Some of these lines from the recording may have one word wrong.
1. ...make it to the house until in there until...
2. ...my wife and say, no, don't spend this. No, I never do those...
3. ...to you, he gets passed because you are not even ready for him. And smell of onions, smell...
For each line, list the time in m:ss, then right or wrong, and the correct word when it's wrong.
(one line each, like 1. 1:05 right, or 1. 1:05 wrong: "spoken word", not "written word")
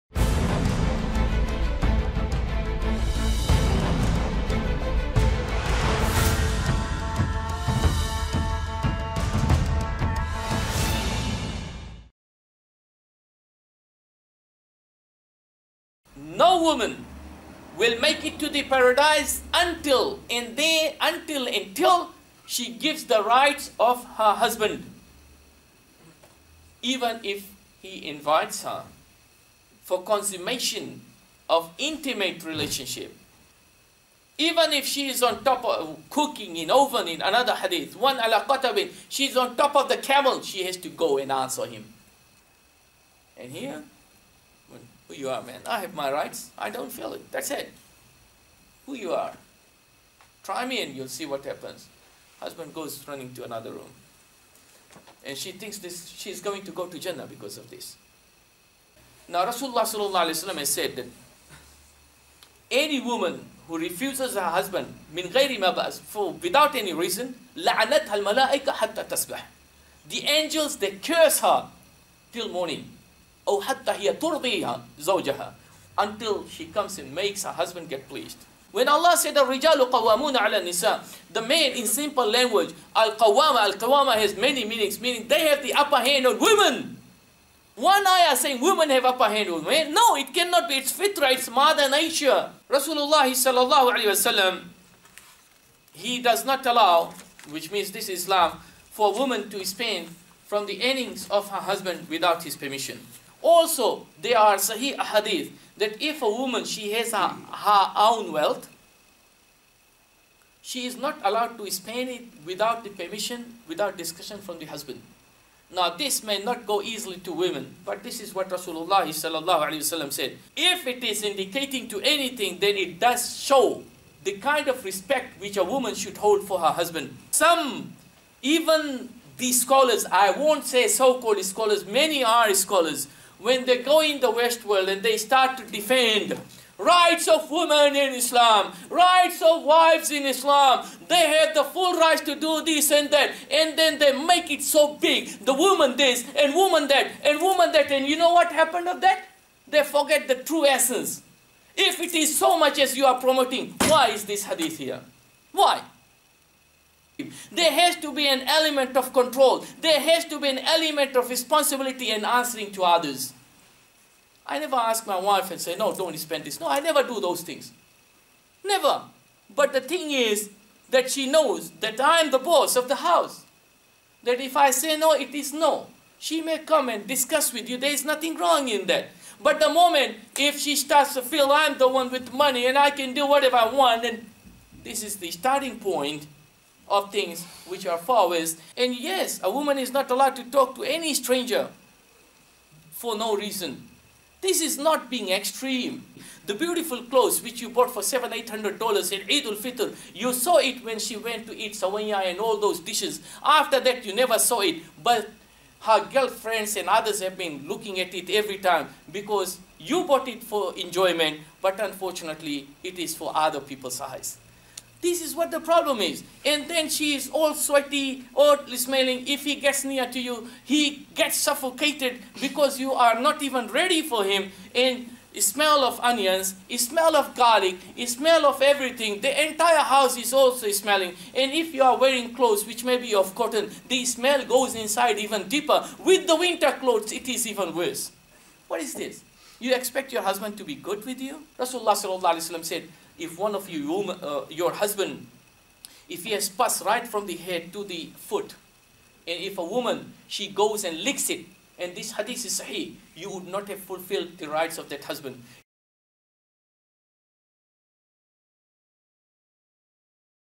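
1. 0:17 wrong: "paradise", not "house"
2. 2:45 right
3. 3:40 wrong: "suffocated", not "passed".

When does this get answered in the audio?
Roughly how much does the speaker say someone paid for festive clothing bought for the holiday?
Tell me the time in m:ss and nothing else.
3:18.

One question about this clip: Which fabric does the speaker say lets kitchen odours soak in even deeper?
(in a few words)
Cotton.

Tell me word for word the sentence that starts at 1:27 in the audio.
One ayah saying women have upper hand on men.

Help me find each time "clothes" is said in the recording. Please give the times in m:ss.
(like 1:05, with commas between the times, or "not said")
3:17, 3:52, 3:56.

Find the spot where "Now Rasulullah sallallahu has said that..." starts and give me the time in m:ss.
0:59.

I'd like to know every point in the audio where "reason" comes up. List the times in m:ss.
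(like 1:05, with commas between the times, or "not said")
1:06, 3:13.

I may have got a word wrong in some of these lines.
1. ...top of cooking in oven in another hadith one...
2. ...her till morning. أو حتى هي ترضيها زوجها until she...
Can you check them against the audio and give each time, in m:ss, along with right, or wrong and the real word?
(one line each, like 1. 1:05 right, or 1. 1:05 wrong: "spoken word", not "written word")
1. 0:35 right
2. 1:11 right.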